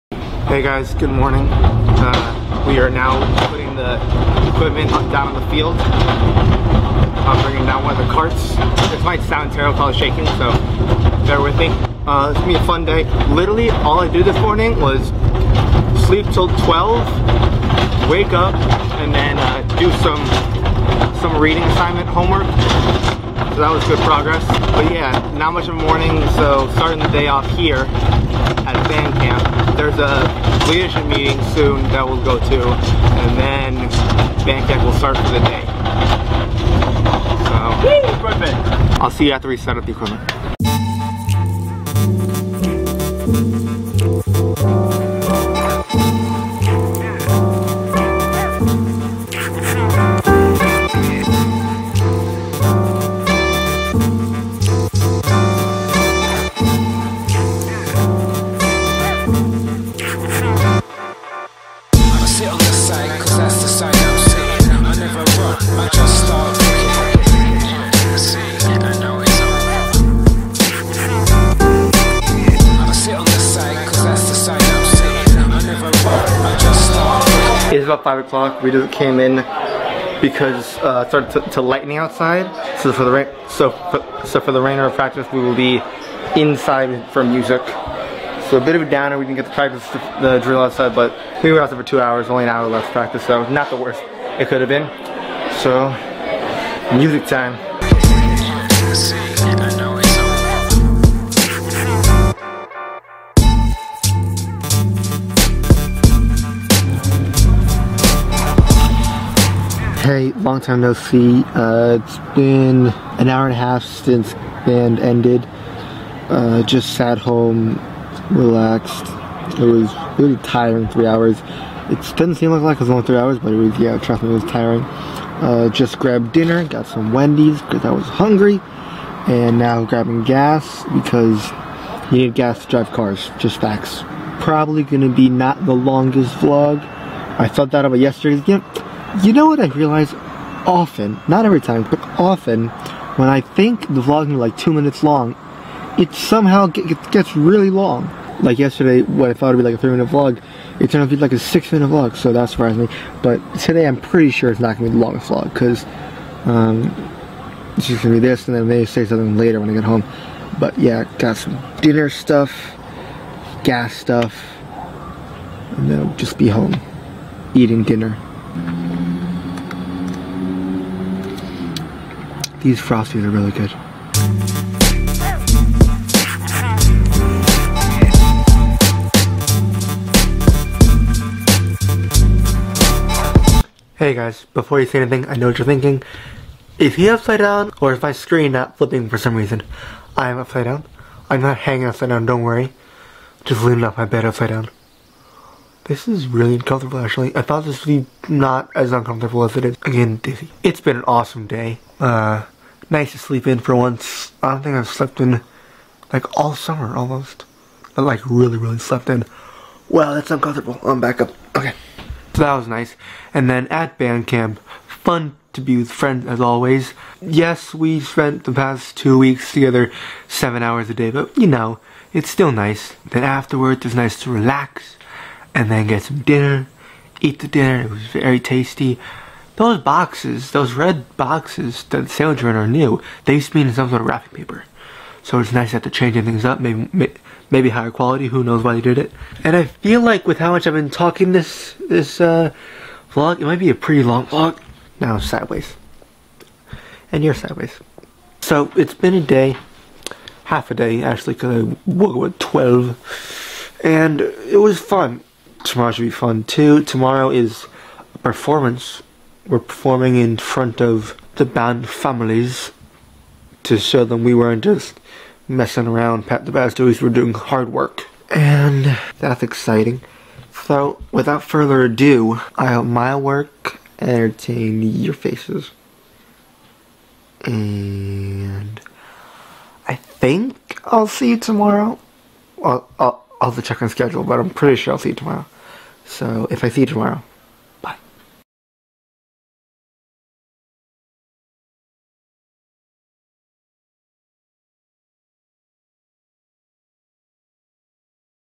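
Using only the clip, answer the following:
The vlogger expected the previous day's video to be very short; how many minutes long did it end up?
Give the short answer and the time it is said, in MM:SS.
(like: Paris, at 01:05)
6, at 02:31.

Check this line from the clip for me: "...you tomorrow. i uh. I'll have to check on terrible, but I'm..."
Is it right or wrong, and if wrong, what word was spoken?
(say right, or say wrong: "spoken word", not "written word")
wrong: "schedule", not "terrible".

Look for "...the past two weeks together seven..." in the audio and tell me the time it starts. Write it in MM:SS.
03:38.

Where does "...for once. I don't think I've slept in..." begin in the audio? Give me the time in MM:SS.
03:23.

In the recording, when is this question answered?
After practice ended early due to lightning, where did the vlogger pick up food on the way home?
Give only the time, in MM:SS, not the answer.
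02:07.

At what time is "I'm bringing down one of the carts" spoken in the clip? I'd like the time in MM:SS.
00:05.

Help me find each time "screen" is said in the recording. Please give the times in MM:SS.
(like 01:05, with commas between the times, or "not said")
03:08.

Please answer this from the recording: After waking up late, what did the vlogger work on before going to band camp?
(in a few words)
reading assignment homework.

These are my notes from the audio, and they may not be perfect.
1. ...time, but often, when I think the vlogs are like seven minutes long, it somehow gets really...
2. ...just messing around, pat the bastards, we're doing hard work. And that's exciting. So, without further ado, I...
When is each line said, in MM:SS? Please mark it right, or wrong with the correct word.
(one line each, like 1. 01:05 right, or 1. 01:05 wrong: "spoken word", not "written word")
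1. 02:21 wrong: "two", not "seven"
2. 04:24 right.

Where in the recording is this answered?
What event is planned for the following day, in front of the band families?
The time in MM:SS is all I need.
04:18.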